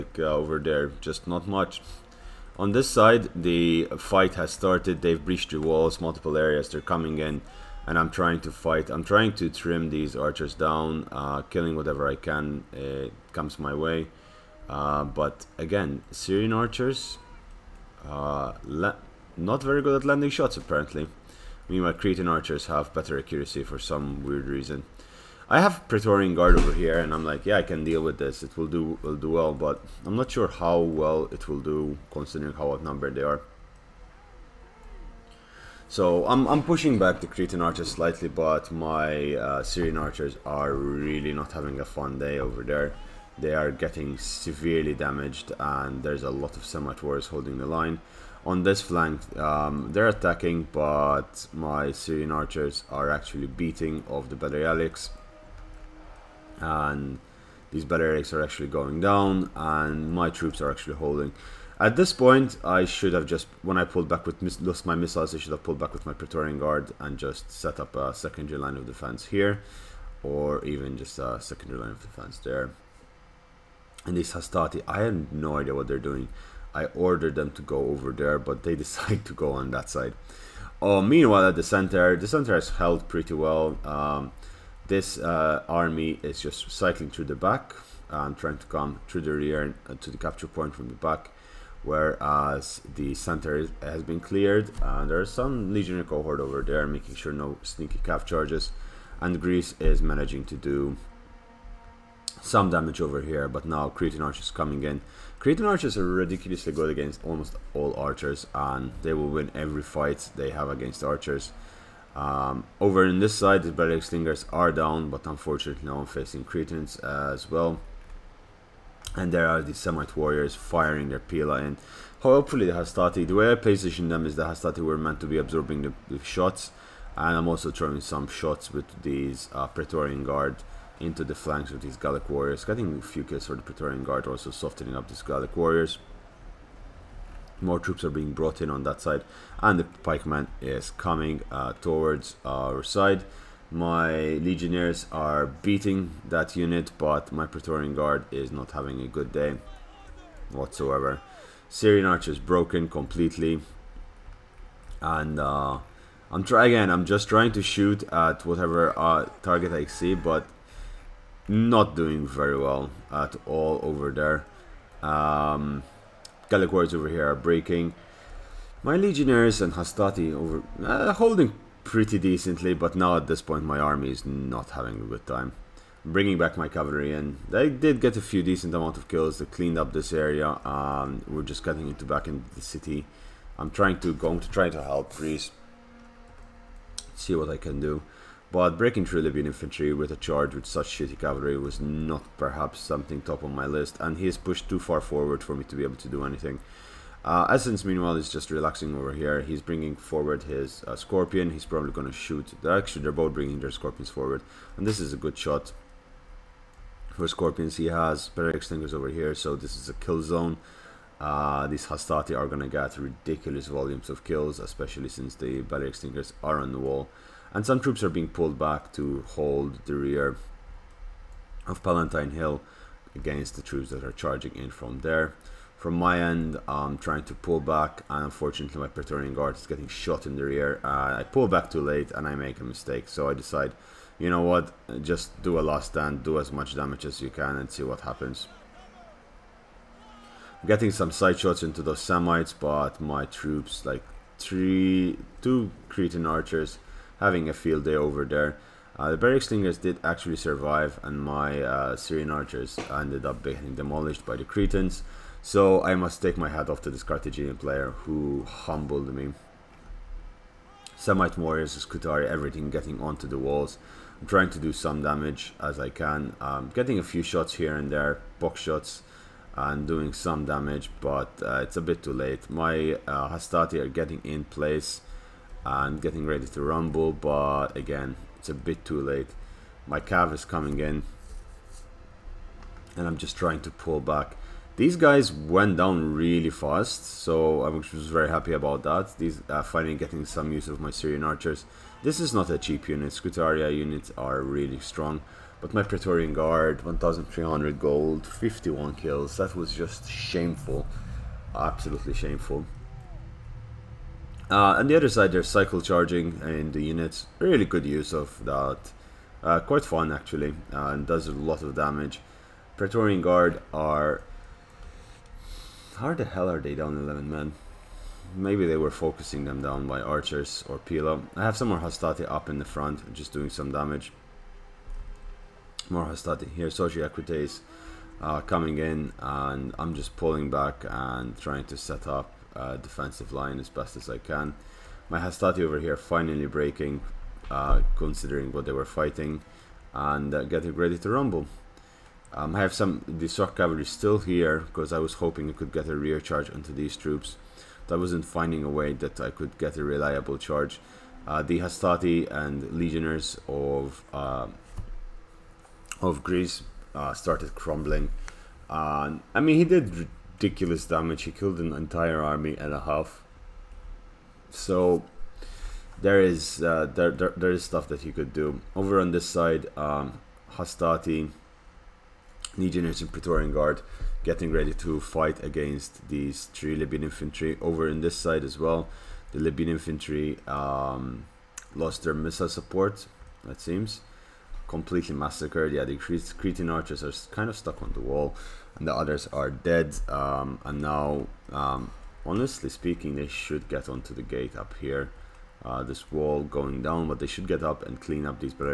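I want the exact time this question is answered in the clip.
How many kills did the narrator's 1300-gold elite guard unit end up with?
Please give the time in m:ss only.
4:58.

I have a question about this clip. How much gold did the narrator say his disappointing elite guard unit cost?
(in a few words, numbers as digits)
1300 gold.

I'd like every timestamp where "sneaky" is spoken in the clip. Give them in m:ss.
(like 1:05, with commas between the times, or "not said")
1:37.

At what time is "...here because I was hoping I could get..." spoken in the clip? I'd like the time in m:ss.
5:44.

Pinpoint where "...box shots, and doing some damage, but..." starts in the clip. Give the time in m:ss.
4:28.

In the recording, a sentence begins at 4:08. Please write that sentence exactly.
Uh, the Balearic Slingers did actually survive, and my uh, Syrian archers ended up being demolished by the Cretans.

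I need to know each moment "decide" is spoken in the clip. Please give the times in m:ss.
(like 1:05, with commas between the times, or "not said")
1:18, 3:53.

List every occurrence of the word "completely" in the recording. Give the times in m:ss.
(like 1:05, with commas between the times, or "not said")
2:32, 6:24.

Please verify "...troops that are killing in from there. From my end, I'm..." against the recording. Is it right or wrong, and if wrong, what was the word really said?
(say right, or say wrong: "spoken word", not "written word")
wrong: "charging", not "killing".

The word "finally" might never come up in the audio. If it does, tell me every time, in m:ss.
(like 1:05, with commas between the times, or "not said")
4:49, 5:35.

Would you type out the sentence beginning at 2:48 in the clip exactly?
My Legionnaires and Hastati over uh, holding pretty decently, but now at this point my army is not having a good time.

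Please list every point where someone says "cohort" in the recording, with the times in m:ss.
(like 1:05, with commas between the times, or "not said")
1:36.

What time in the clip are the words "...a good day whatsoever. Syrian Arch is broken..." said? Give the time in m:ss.
2:29.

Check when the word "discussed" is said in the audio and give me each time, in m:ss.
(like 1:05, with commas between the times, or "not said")
not said.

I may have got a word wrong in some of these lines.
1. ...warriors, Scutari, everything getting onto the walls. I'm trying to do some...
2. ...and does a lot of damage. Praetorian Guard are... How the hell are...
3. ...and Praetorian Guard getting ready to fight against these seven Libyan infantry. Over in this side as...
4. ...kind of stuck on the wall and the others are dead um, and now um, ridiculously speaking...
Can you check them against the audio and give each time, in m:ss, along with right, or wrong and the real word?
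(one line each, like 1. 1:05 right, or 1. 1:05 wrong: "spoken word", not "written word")
1. 4:21 right
2. 5:10 right
3. 6:13 wrong: "three", not "seven"
4. 6:27 wrong: "honestly", not "ridiculously".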